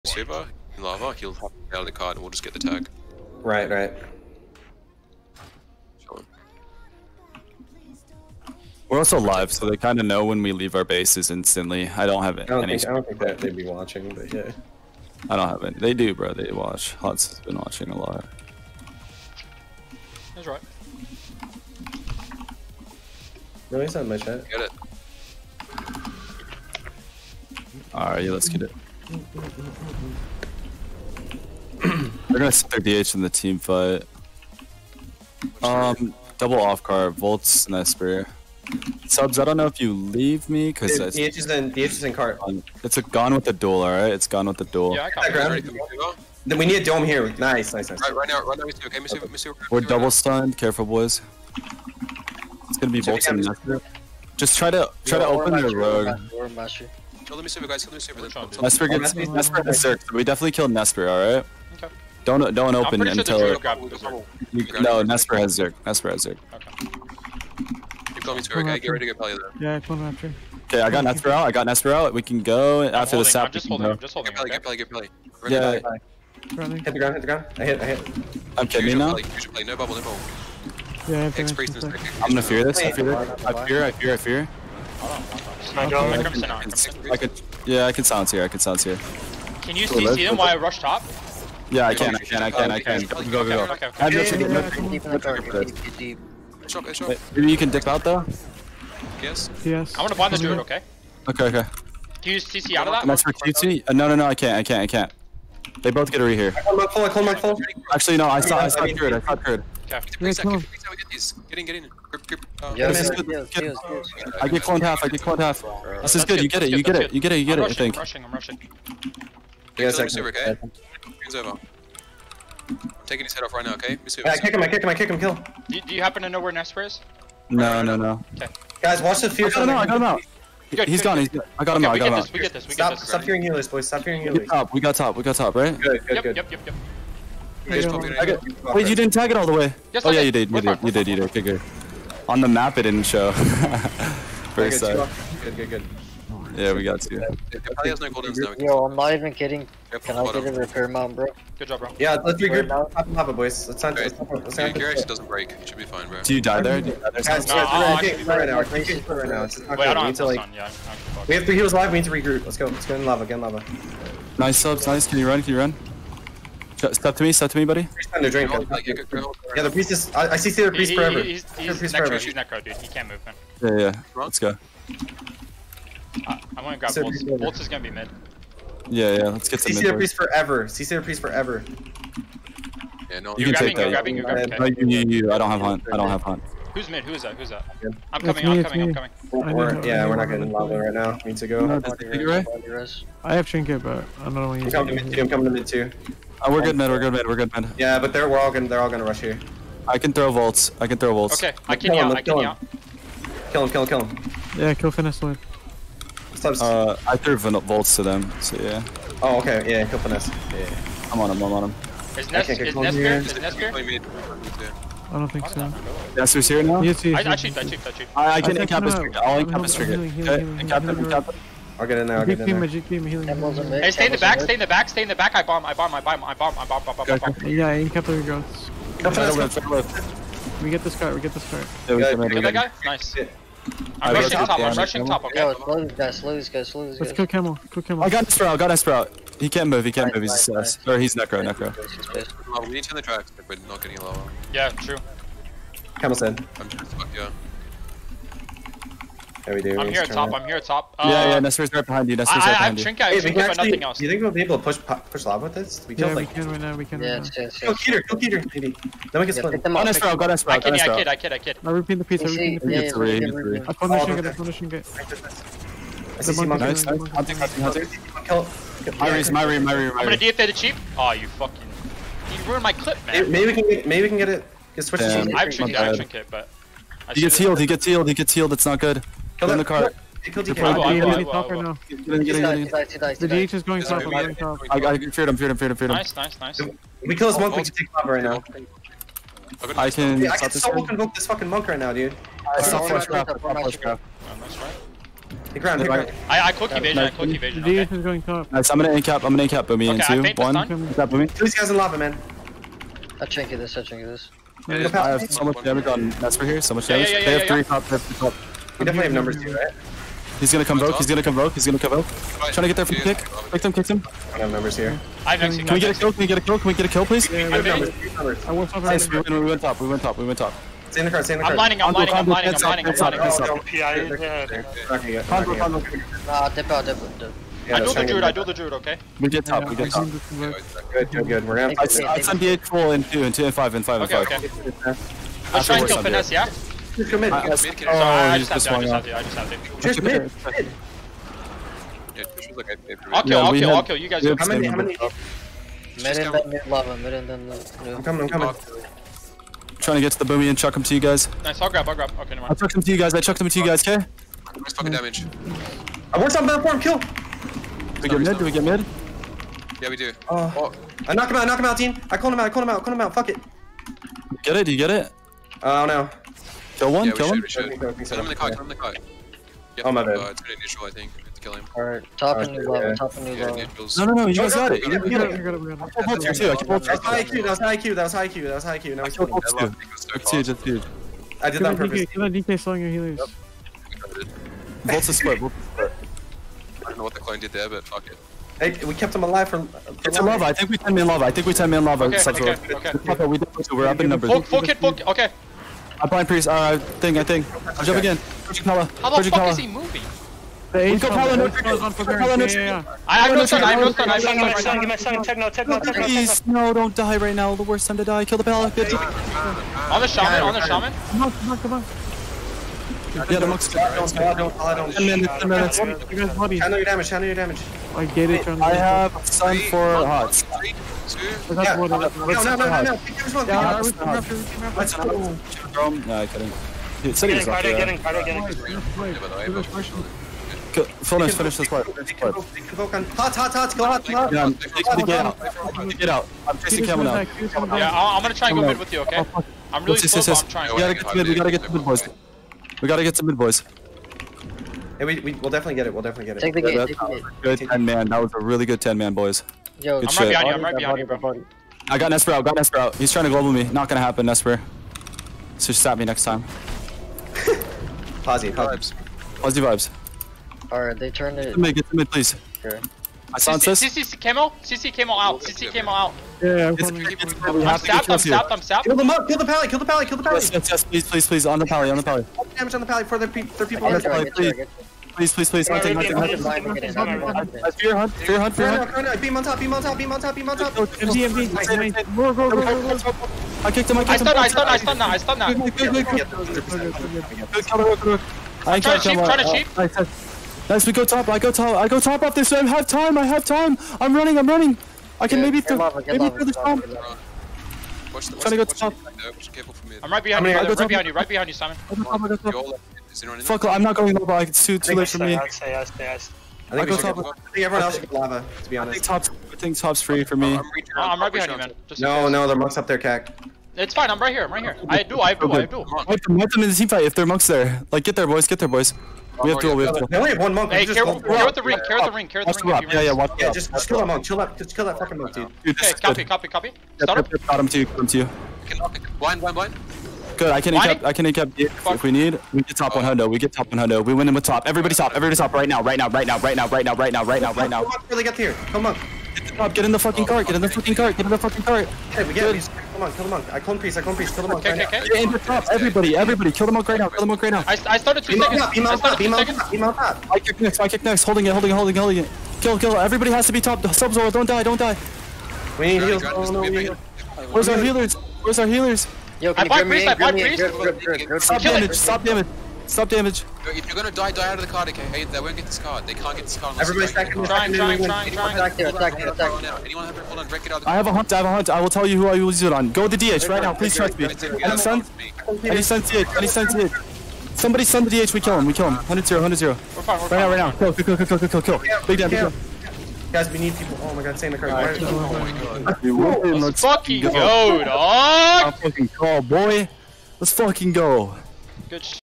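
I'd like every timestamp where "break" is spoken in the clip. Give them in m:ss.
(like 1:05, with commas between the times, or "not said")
2:35, 9:30.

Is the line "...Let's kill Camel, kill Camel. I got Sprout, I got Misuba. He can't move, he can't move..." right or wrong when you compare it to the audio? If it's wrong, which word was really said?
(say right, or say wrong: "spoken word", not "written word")
wrong: "Sprout", not "Misuba".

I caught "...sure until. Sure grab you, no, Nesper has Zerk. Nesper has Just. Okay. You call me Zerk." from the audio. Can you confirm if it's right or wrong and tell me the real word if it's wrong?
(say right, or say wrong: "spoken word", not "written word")
wrong: "Zerk", not "Just".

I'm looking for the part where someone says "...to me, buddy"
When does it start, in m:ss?
2:47.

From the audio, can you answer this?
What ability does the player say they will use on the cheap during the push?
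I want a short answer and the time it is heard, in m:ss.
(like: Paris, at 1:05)
DFA, at 4:29.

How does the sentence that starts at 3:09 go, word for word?
We're, we're, yeah, we're not getting lava right now.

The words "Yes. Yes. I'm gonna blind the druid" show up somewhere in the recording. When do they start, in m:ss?
1:39.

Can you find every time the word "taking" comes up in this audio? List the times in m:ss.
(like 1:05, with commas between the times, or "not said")
2:03.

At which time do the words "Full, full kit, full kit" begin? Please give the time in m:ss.
6:34.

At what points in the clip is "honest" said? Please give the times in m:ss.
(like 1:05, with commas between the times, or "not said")
8:28.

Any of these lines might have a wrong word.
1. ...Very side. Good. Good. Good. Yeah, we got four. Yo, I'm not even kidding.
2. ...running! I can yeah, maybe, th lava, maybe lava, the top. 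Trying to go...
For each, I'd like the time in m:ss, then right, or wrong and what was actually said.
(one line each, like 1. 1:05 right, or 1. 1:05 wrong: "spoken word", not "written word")
1. 2:24 wrong: "two", not "four"
2. 8:14 right.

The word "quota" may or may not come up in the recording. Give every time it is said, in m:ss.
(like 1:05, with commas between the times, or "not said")
not said.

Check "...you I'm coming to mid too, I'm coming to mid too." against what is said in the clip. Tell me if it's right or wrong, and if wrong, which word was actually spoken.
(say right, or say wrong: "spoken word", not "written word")
right.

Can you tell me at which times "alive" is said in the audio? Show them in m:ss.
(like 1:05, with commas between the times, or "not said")
6:29.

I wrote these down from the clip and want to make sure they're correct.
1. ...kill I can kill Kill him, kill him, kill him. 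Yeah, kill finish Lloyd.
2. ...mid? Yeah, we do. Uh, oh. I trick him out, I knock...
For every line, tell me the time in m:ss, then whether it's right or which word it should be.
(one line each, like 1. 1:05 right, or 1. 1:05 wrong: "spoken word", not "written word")
1. 3:21 right
2. 5:58 wrong: "knock", not "trick".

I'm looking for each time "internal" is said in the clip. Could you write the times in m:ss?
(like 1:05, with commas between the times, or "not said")
not said.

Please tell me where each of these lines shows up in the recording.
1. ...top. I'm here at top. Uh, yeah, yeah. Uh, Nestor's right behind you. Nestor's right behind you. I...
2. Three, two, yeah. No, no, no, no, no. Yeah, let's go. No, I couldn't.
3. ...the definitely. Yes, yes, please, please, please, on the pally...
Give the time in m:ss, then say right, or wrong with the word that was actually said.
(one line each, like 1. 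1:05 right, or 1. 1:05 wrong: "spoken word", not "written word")
1. 4:10 right
2. 7:00 right
3. 7:50 wrong: "pally", not "definitely".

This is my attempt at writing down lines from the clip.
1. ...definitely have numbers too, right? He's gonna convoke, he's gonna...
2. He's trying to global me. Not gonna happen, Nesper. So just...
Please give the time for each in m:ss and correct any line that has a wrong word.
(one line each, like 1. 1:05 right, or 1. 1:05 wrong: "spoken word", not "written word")
1. 5:08 right
2. 7:32 right.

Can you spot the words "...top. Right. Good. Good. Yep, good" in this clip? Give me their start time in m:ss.
2:15.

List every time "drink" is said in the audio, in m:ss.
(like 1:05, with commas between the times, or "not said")
2:48.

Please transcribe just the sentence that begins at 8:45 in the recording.
dude okay, copy, copy, copy, got him to you, got him to you.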